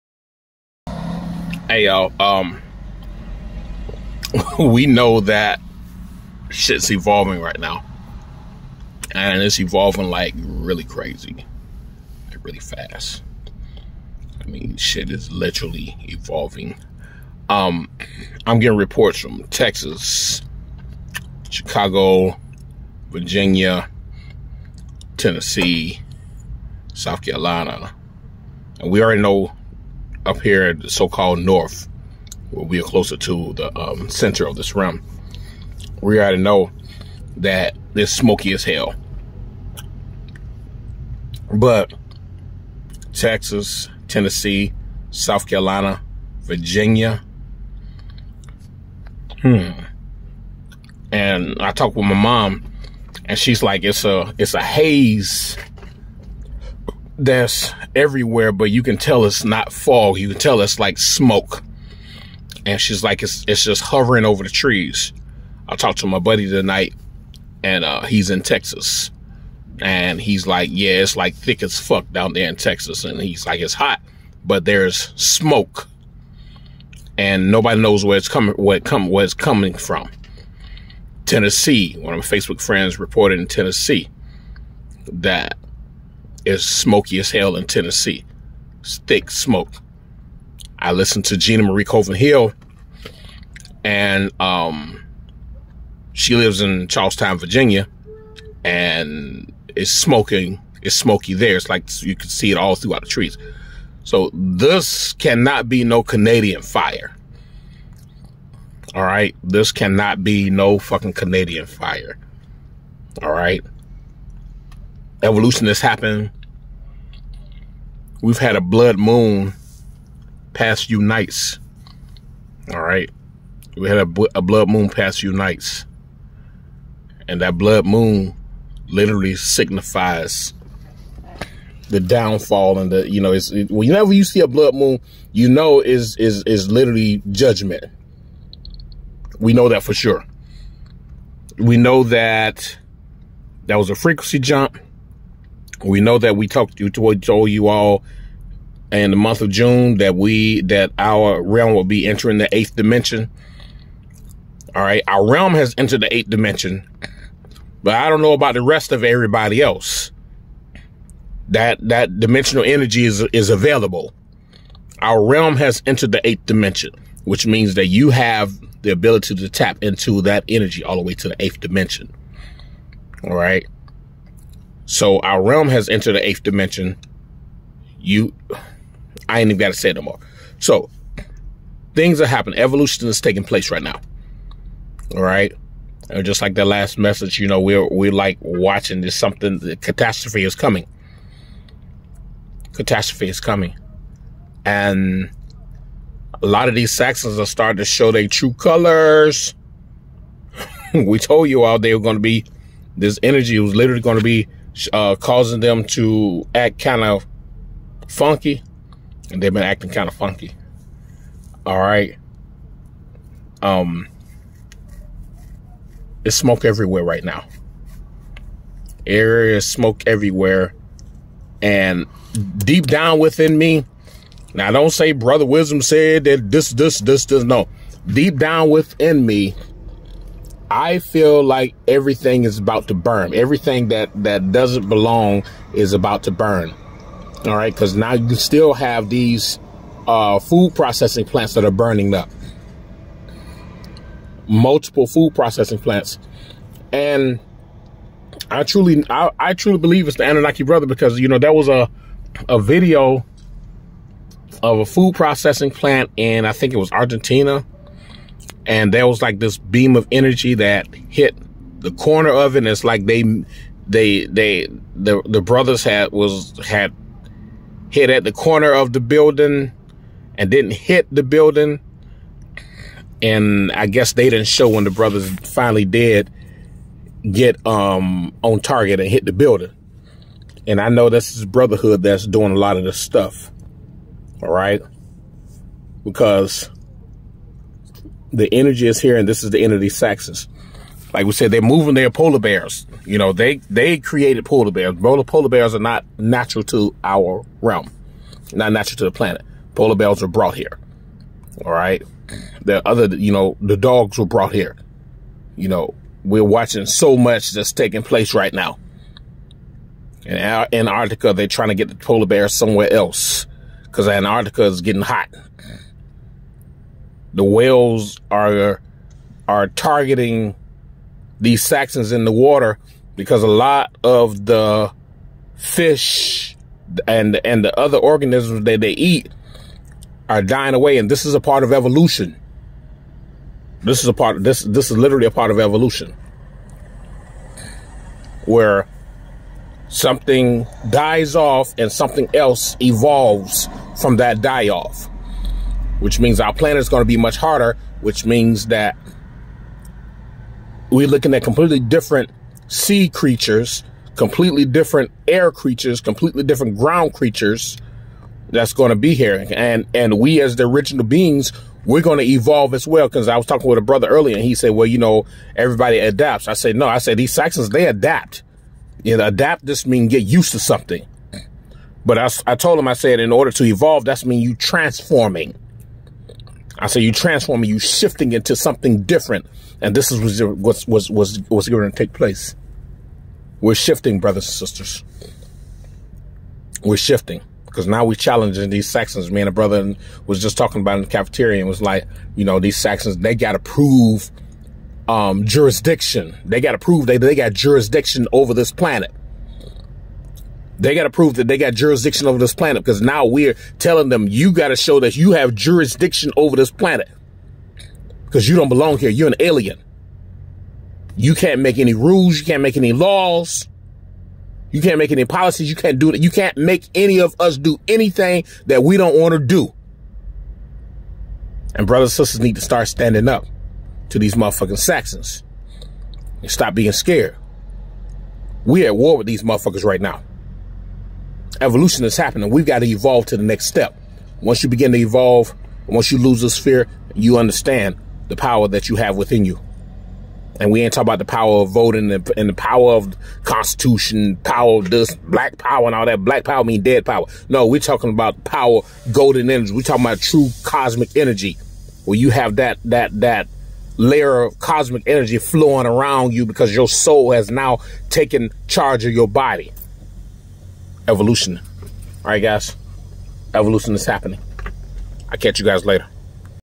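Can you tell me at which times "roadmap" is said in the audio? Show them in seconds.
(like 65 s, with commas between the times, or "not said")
not said.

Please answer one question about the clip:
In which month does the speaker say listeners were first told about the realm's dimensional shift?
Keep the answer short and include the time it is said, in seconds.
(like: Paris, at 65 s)
June, at 149 s.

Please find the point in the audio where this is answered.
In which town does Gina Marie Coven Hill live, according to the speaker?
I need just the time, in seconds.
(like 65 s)
96 s.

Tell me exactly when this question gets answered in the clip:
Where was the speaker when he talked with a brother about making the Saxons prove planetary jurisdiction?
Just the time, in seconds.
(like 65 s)
391 s.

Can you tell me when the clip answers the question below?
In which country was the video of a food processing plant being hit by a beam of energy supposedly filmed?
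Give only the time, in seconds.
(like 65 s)
256 s.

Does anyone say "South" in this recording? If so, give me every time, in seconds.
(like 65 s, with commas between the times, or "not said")
26 s, 45 s.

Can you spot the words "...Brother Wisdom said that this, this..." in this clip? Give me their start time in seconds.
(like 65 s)
225 s.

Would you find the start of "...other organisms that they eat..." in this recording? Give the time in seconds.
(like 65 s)
327 s.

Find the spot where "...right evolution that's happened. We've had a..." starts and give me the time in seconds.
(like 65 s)
113 s.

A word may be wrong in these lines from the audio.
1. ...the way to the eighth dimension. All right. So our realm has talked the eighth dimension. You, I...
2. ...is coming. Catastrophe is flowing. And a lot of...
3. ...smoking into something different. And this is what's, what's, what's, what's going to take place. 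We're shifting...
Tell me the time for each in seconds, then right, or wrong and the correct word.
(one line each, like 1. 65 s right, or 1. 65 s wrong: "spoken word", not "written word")
1. 170 s wrong: "entered", not "talked"
2. 190 s wrong: "coming", not "flowing"
3. 377 s wrong: "shifting", not "smoking".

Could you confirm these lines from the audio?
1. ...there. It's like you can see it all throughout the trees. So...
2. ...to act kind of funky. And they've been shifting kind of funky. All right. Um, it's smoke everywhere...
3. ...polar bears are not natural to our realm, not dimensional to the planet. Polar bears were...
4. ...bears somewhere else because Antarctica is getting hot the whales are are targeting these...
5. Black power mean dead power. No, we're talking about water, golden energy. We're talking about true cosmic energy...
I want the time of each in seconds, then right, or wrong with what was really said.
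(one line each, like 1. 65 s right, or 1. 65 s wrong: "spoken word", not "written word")
1. 101 s right
2. 205 s wrong: "acting", not "shifting"
3. 295 s wrong: "natural", not "dimensional"
4. 312 s right
5. 446 s wrong: "power", not "water".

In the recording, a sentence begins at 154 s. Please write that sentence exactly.
All right, our realm has entered the eighth dimension, but I don't know about the rest of everybody else.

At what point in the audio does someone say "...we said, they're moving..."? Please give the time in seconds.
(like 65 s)
291 s.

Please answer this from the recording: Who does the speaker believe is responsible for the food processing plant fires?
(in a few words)
The Anunnaki.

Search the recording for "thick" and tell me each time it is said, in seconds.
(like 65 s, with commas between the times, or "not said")
71 s, 88 s.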